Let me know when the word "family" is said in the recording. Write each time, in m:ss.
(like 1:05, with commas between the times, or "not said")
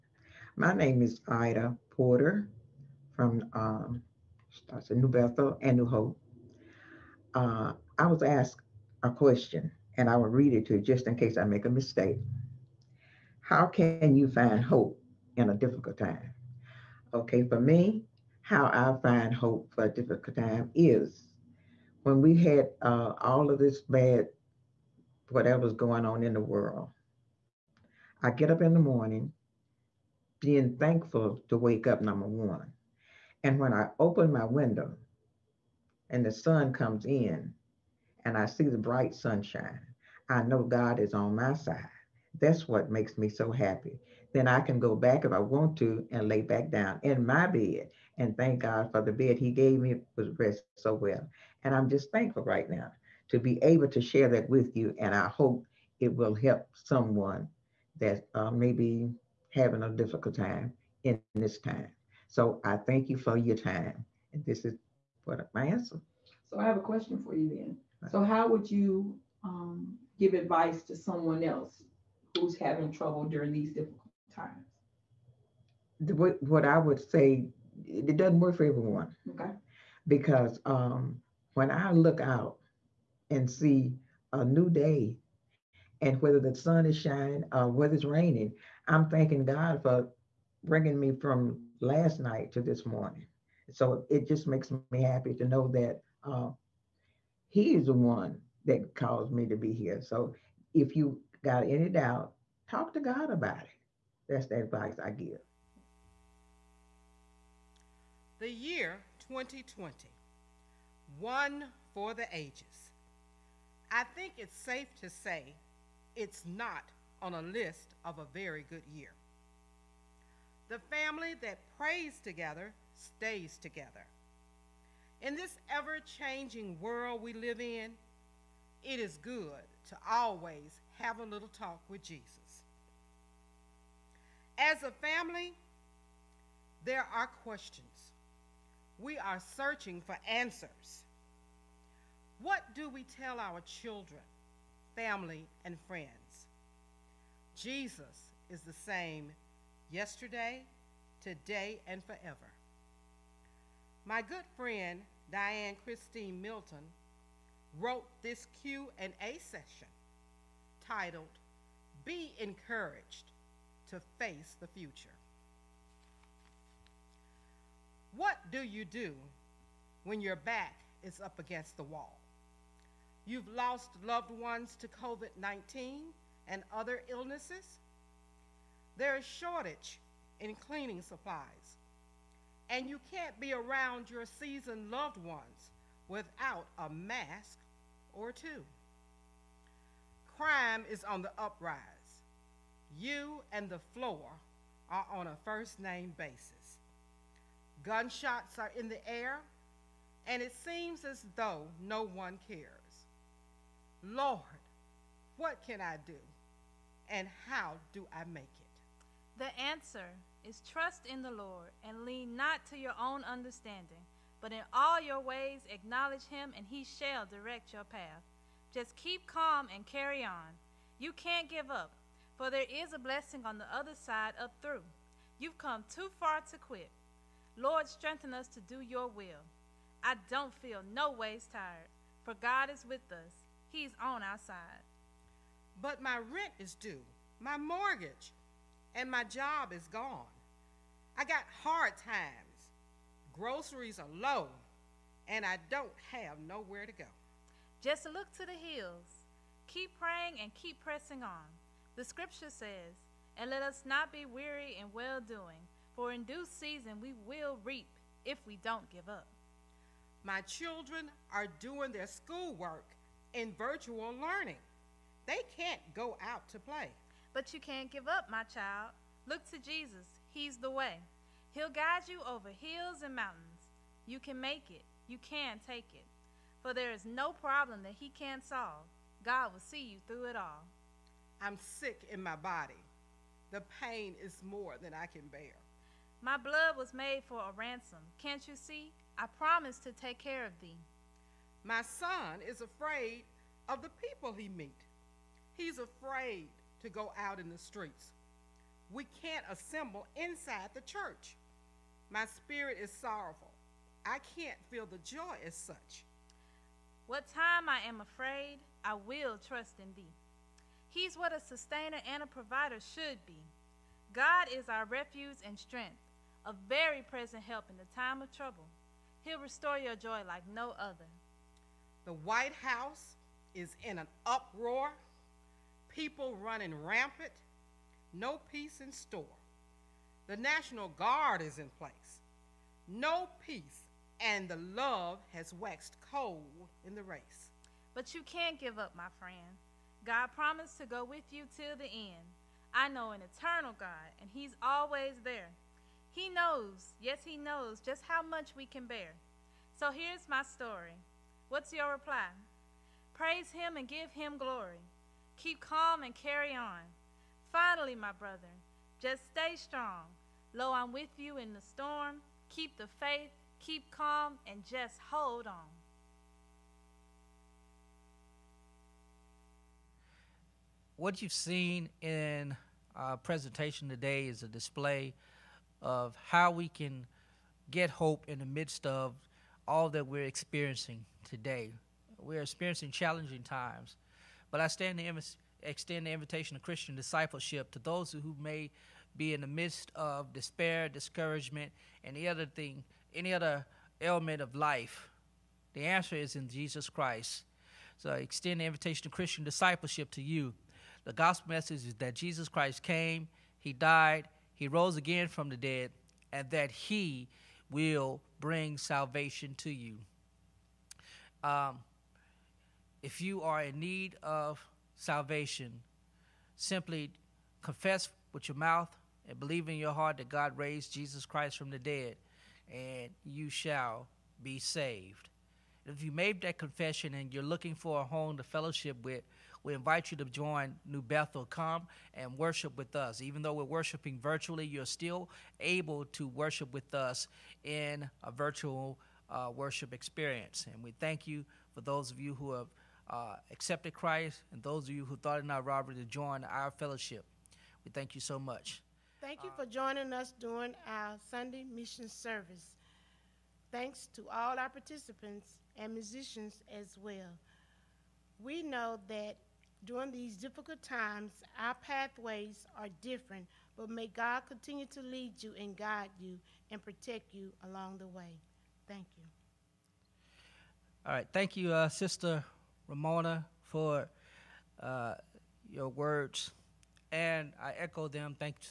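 2:00, 2:15, 2:24.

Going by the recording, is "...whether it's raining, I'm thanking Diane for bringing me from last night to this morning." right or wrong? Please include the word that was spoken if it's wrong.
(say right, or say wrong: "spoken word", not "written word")
wrong: "God", not "Diane".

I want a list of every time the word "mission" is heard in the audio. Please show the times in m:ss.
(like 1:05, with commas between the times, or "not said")
7:31.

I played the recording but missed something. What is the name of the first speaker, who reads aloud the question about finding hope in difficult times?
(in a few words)
Ida Porter.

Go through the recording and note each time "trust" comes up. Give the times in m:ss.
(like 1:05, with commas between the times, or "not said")
3:30, 5:09.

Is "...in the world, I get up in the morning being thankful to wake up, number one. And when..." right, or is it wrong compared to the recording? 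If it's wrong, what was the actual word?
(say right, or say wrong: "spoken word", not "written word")
right.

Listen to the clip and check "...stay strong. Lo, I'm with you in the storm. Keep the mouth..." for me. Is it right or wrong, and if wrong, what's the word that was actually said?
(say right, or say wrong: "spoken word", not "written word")
wrong: "faith", not "mouth".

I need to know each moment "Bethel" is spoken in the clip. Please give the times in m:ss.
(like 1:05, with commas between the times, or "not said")
0:05, 7:11.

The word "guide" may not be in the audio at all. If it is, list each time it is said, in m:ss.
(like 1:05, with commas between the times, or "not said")
4:31, 7:45.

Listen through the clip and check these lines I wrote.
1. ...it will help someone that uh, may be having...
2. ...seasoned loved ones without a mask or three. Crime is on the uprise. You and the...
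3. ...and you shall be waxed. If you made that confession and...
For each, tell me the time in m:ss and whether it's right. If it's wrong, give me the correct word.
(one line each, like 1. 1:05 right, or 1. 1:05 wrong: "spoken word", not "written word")
1. 0:55 right
2. 3:04 wrong: "two", not "three"
3. 7:02 wrong: "saved", not "waxed".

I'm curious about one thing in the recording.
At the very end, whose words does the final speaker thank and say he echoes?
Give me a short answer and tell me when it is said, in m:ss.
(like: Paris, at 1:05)
Sister Ramona, at 7:51.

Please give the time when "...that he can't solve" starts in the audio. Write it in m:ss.
4:37.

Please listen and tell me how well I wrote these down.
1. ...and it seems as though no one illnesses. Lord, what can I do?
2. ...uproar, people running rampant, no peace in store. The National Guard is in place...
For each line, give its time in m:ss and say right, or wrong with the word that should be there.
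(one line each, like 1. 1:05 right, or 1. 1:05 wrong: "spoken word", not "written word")
1. 3:20 wrong: "cares", not "illnesses"
2. 5:24 right.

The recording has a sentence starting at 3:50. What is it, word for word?
I don't feel no ways tired, for God is with us.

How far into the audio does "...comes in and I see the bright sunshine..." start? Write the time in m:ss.
0:36.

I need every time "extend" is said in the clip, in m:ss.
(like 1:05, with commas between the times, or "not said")
6:25, 6:38.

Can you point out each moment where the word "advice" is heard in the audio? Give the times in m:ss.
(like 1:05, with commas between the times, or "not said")
1:10, 1:44.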